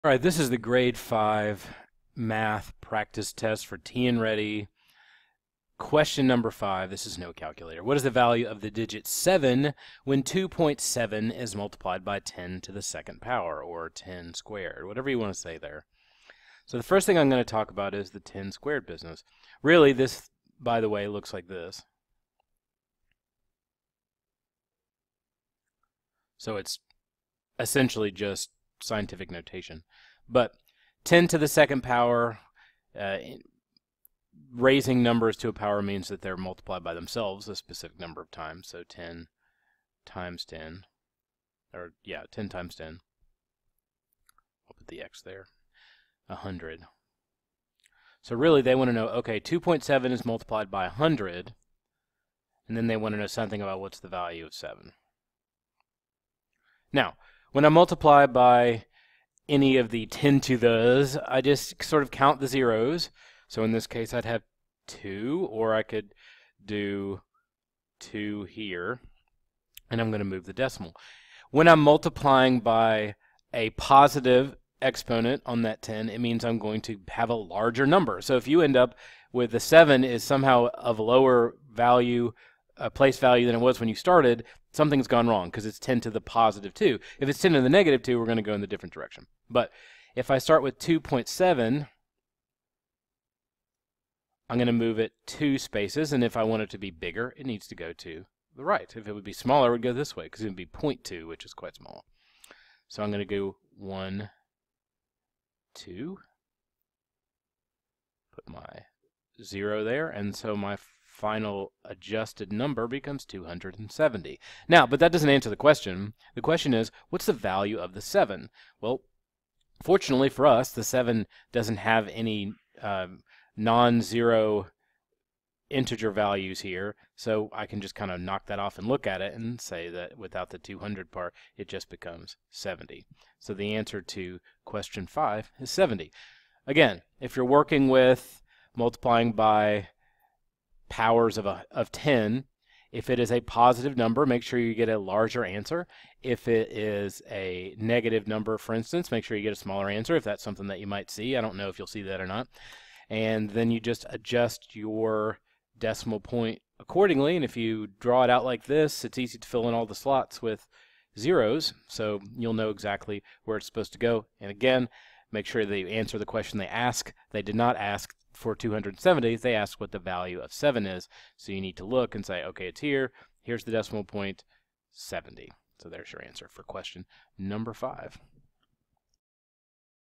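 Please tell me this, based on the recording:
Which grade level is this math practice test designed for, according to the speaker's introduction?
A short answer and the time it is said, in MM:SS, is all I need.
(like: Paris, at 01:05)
Grade 5, at 00:00.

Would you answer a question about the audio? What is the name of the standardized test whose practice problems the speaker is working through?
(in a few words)
TNReady.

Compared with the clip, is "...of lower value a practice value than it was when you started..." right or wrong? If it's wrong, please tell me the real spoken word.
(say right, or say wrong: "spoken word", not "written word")
wrong: "place", not "practice".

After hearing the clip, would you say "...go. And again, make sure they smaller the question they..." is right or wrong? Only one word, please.
wrong.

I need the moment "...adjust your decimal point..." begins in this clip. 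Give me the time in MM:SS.
02:34.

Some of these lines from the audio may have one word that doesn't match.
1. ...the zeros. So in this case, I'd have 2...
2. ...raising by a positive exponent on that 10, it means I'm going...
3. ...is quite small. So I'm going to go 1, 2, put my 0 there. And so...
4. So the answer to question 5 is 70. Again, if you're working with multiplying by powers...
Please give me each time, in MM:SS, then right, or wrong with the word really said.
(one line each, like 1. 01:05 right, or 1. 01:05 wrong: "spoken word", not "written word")
1. 01:02 right
2. 01:11 wrong: "multiplying", not "raising"
3. 01:41 right
4. 02:13 right.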